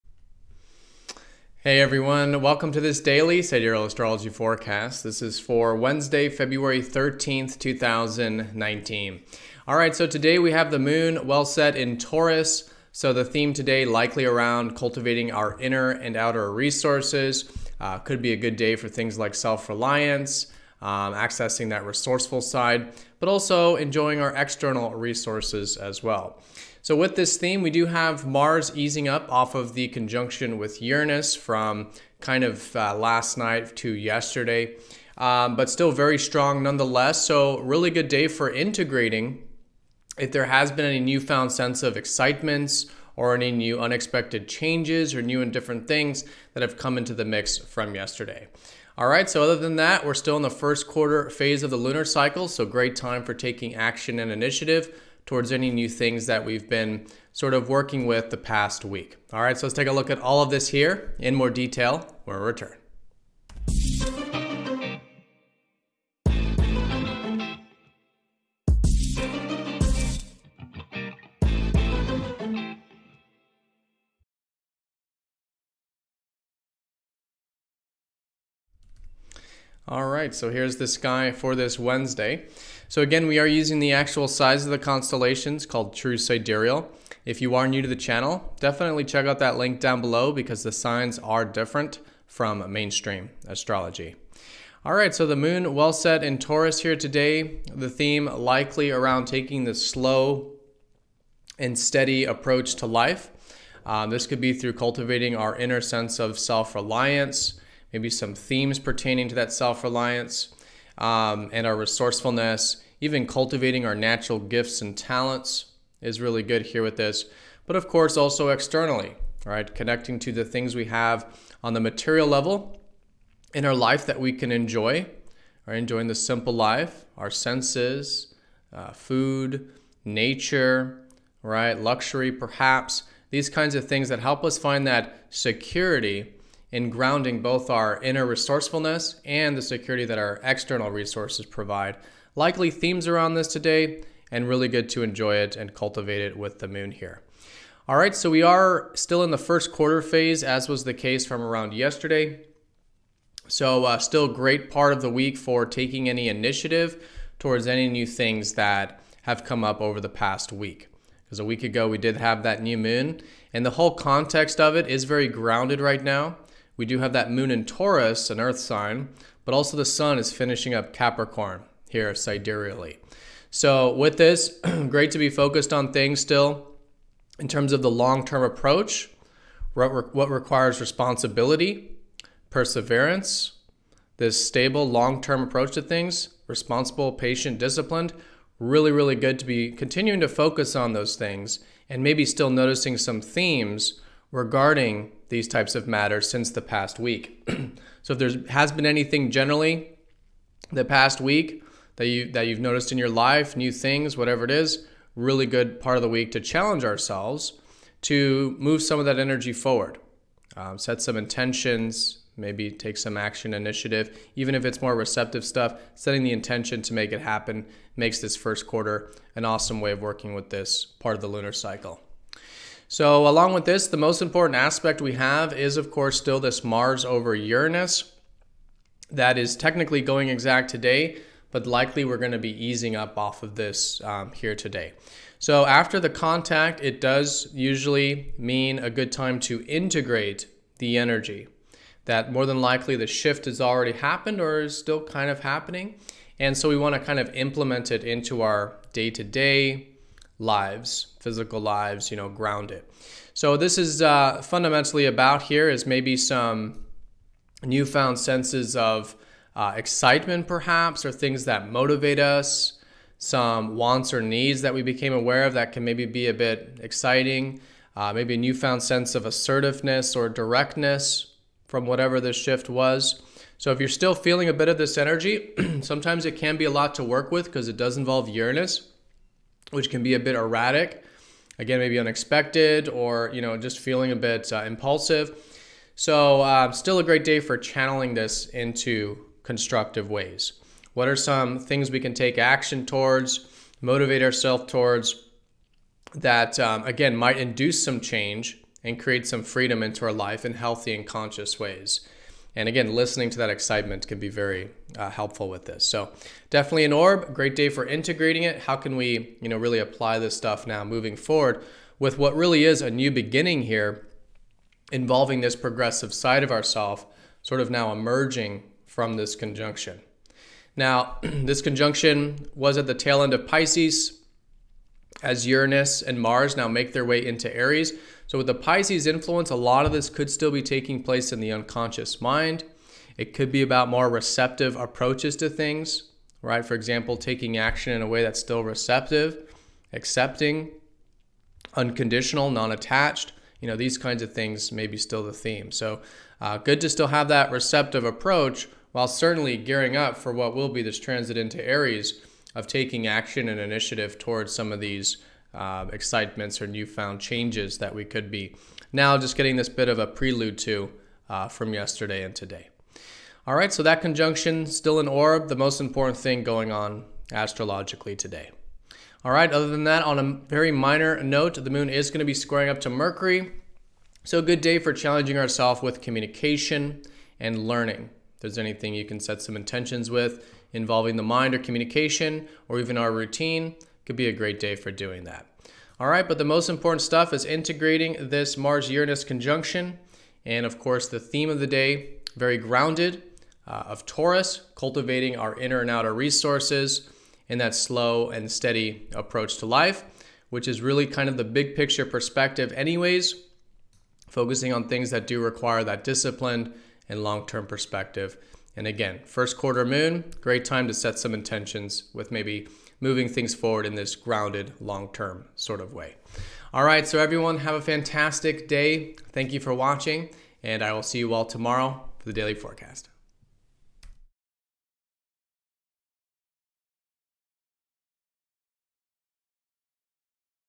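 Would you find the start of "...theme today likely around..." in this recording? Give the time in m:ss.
0:13.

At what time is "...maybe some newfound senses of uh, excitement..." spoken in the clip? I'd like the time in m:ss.
4:15.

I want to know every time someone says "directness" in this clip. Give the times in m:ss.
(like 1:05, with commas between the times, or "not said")
4:30.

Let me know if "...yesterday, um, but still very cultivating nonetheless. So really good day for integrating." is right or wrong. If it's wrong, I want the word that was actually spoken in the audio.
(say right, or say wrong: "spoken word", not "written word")
wrong: "strong", not "cultivating".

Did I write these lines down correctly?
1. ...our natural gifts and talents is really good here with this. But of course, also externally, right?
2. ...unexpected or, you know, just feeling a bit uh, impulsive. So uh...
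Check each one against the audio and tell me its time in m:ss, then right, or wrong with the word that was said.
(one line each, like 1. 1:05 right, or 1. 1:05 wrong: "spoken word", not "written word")
1. 1:53 right
2. 4:41 right.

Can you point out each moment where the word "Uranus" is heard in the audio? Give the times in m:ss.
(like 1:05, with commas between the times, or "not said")
0:30, 3:47, 4:38, 5:25, 6:28.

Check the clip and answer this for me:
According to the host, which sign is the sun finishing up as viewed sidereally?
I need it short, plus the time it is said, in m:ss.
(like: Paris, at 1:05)
Capricorn, at 2:50.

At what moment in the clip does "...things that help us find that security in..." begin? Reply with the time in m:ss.
2:13.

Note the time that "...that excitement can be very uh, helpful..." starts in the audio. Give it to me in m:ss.
5:03.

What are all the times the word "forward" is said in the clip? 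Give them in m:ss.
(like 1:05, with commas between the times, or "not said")
3:29, 5:11, 6:53.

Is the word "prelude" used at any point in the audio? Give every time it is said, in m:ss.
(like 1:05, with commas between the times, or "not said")
6:00.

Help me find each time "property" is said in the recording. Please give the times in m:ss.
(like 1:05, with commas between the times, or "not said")
not said.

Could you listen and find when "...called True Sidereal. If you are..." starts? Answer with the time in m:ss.
1:25.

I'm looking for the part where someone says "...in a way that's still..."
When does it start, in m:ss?
5:37.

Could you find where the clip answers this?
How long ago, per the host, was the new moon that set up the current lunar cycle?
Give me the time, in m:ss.
2:41.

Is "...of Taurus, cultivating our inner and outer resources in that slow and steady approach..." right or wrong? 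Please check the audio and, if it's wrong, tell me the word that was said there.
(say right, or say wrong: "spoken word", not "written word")
right.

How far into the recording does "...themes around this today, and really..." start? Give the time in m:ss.
2:22.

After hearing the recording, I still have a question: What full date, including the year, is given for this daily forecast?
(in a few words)
February 13, 2019.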